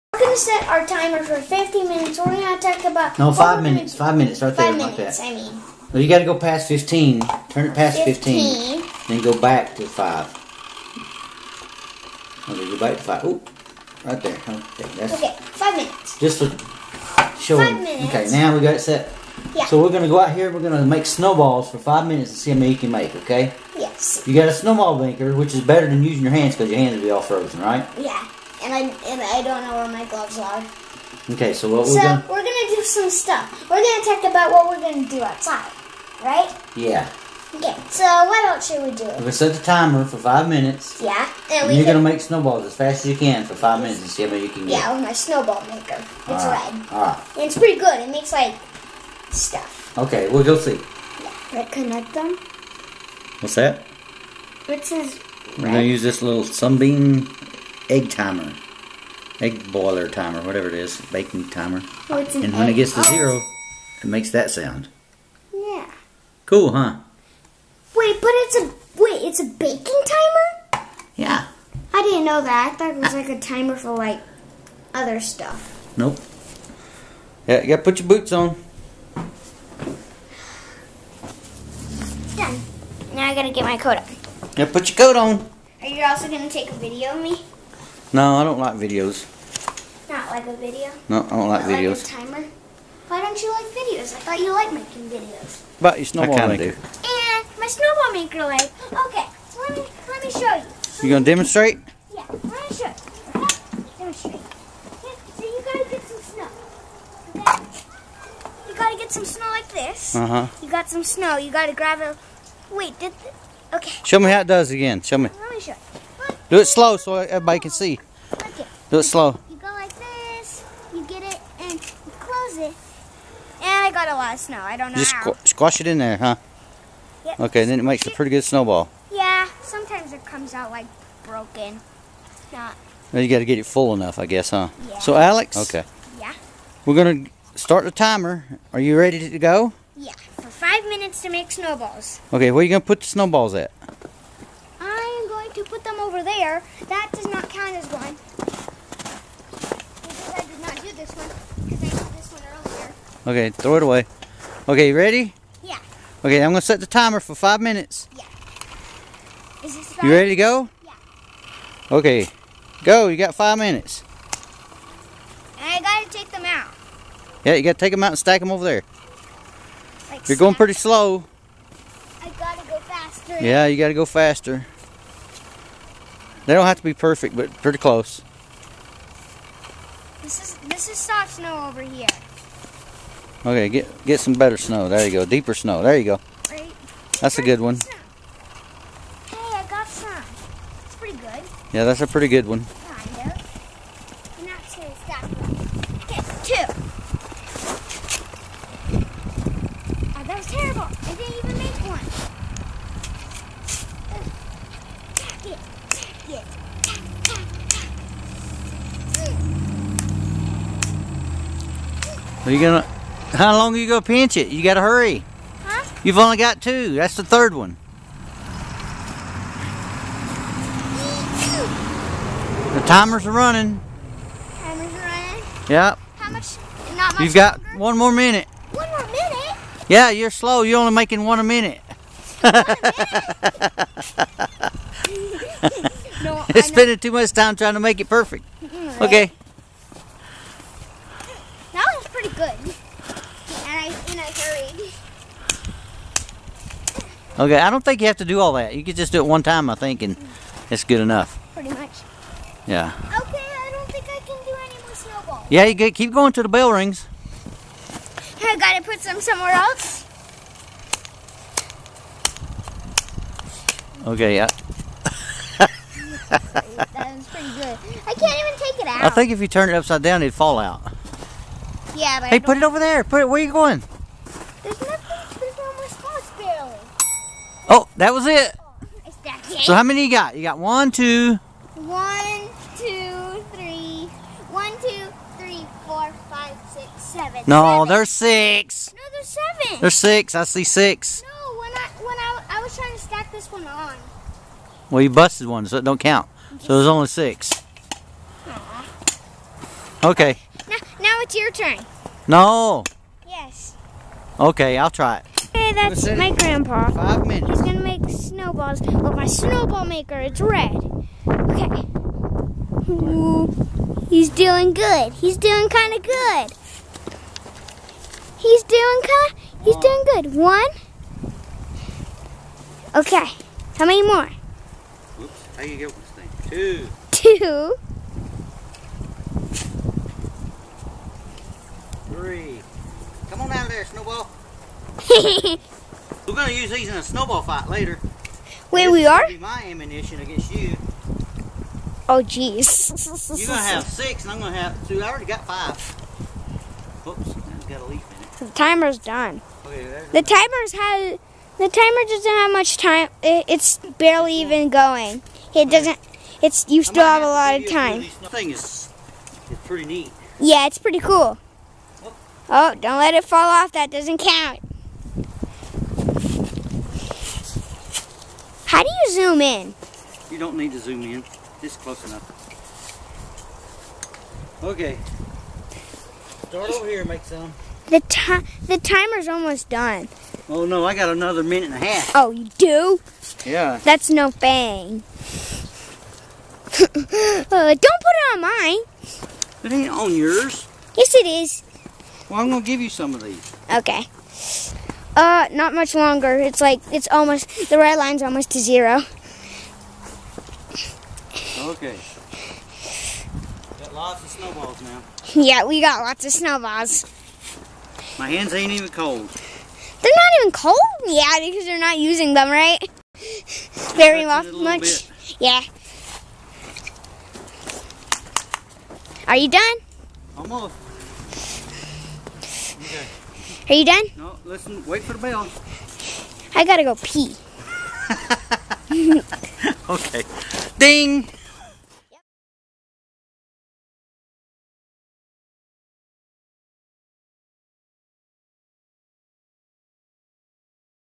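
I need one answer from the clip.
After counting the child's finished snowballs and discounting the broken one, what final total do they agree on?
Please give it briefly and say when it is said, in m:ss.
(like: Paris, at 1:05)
6, at 4:56.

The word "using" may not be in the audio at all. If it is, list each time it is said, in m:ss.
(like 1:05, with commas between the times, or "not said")
0:26, 6:51.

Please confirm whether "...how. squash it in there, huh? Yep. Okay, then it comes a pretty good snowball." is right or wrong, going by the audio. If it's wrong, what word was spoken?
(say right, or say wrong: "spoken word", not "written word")
wrong: "makes", not "comes".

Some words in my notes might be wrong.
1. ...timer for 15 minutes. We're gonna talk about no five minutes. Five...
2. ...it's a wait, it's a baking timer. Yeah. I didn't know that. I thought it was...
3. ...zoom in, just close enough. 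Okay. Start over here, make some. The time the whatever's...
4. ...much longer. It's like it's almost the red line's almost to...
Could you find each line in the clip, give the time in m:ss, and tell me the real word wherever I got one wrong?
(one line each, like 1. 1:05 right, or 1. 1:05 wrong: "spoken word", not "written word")
1. 0:00 right
2. 1:08 right
3. 6:10 wrong: "timer", not "whatever"
4. 6:35 right.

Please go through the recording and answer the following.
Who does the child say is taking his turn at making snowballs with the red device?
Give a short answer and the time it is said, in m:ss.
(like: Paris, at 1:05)
My grandpa, at 5:06.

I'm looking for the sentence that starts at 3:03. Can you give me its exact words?
Okay, get get some better snow.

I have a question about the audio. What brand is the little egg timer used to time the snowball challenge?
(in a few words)
Sunbeam.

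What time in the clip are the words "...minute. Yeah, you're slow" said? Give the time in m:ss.
3:49.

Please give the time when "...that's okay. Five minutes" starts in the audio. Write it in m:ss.
0:14.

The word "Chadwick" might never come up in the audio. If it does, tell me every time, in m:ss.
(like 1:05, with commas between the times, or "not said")
not said.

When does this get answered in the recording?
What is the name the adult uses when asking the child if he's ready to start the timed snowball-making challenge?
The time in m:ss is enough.
2:15.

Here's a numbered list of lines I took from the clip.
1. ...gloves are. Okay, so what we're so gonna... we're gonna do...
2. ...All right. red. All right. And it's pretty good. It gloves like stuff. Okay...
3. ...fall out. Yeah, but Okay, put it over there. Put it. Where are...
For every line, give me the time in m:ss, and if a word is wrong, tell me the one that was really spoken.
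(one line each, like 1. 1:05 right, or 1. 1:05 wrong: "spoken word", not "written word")
1. 0:30 right
2. 0:46 wrong: "makes", not "gloves"
3. 4:30 wrong: "Hey", not "Okay".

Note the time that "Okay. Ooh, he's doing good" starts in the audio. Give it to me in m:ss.
5:11.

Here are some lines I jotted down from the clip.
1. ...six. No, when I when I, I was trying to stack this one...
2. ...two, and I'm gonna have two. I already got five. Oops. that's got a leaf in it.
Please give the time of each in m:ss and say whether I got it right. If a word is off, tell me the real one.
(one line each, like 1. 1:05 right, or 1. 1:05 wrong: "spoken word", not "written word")
1. 4:50 right
2. 5:43 wrong: "six", not "two".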